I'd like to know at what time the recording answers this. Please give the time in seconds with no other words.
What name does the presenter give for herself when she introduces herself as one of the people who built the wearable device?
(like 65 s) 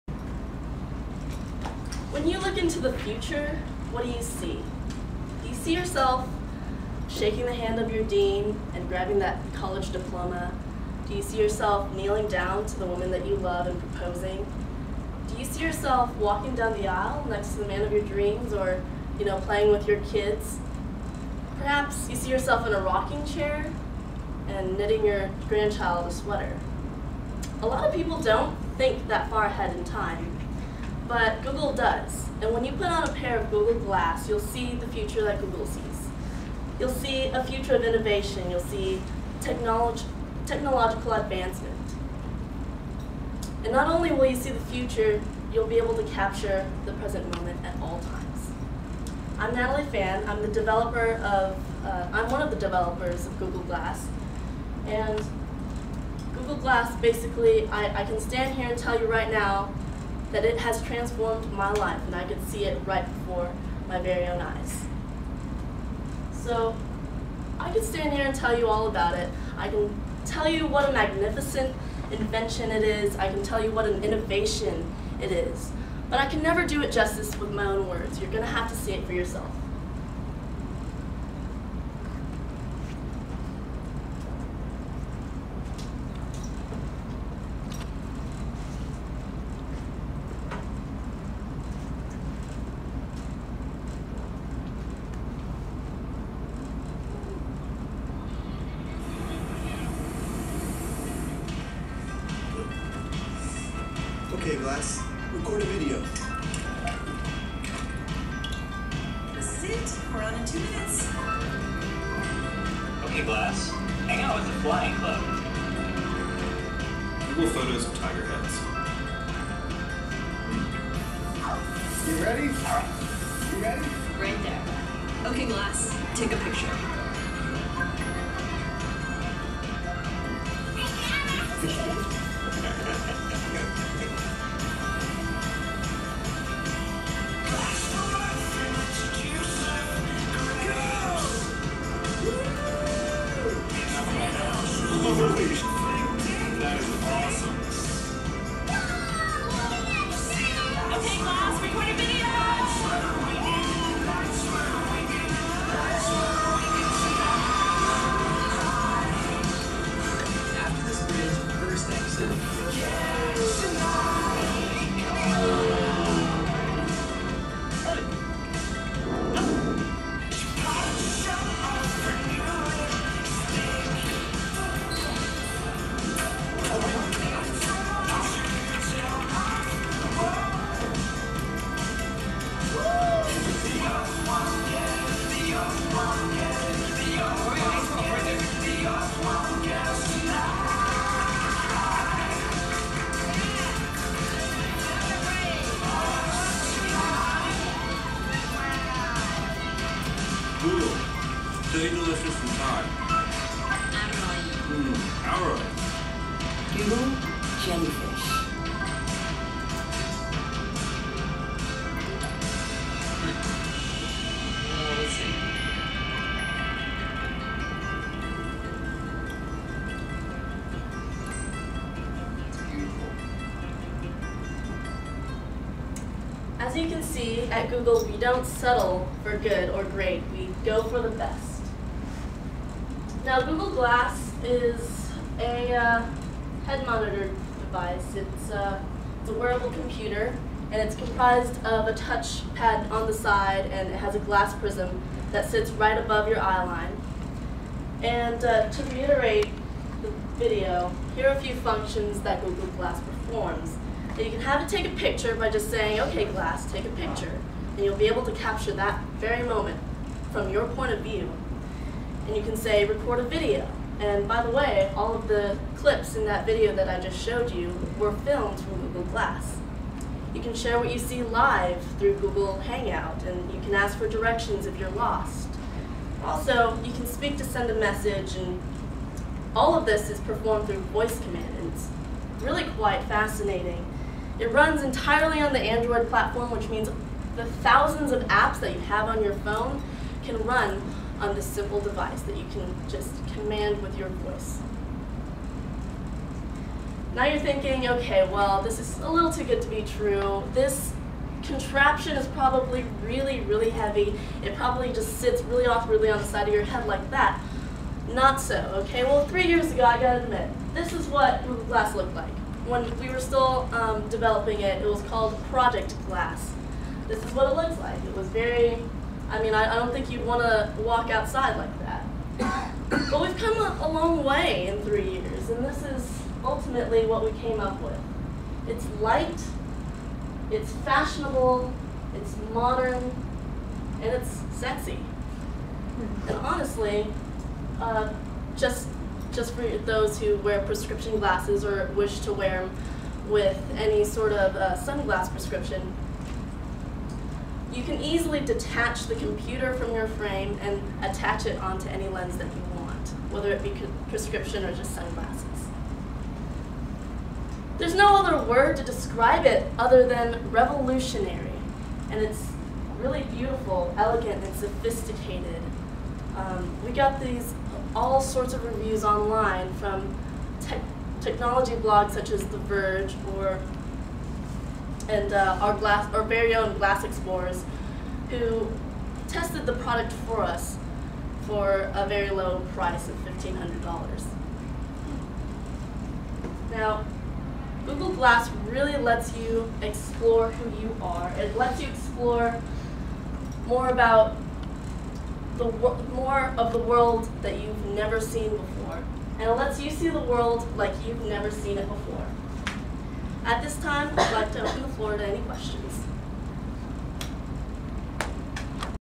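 49 s.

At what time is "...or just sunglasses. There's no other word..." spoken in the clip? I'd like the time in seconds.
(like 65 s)
354 s.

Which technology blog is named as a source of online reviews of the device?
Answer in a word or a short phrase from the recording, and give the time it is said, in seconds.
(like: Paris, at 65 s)
The Verge, at 372 s.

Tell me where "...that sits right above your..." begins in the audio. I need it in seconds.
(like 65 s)
245 s.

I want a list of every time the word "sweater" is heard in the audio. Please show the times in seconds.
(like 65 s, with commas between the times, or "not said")
26 s.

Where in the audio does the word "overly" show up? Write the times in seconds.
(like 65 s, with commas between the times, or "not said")
not said.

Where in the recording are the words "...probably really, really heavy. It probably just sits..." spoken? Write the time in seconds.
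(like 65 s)
302 s.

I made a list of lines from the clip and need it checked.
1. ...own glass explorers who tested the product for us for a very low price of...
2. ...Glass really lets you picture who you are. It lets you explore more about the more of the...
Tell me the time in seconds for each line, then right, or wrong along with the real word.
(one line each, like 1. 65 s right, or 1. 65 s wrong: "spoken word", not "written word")
1. 376 s right
2. 388 s wrong: "explore", not "picture".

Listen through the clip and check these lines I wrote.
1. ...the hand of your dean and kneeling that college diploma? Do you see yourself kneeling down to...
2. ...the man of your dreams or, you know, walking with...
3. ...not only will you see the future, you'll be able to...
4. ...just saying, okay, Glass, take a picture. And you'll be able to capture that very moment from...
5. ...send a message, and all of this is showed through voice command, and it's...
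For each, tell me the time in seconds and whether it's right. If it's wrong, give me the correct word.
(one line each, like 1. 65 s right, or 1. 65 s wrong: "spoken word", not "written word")
1. 7 s wrong: "grabbing", not "kneeling"
2. 17 s wrong: "playing", not "walking"
3. 43 s right
4. 255 s right
5. 277 s wrong: "performed", not "showed".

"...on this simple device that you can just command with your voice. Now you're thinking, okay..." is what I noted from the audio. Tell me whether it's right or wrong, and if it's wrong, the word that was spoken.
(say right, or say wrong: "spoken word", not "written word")
right.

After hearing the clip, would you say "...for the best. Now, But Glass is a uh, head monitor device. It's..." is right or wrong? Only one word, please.
wrong.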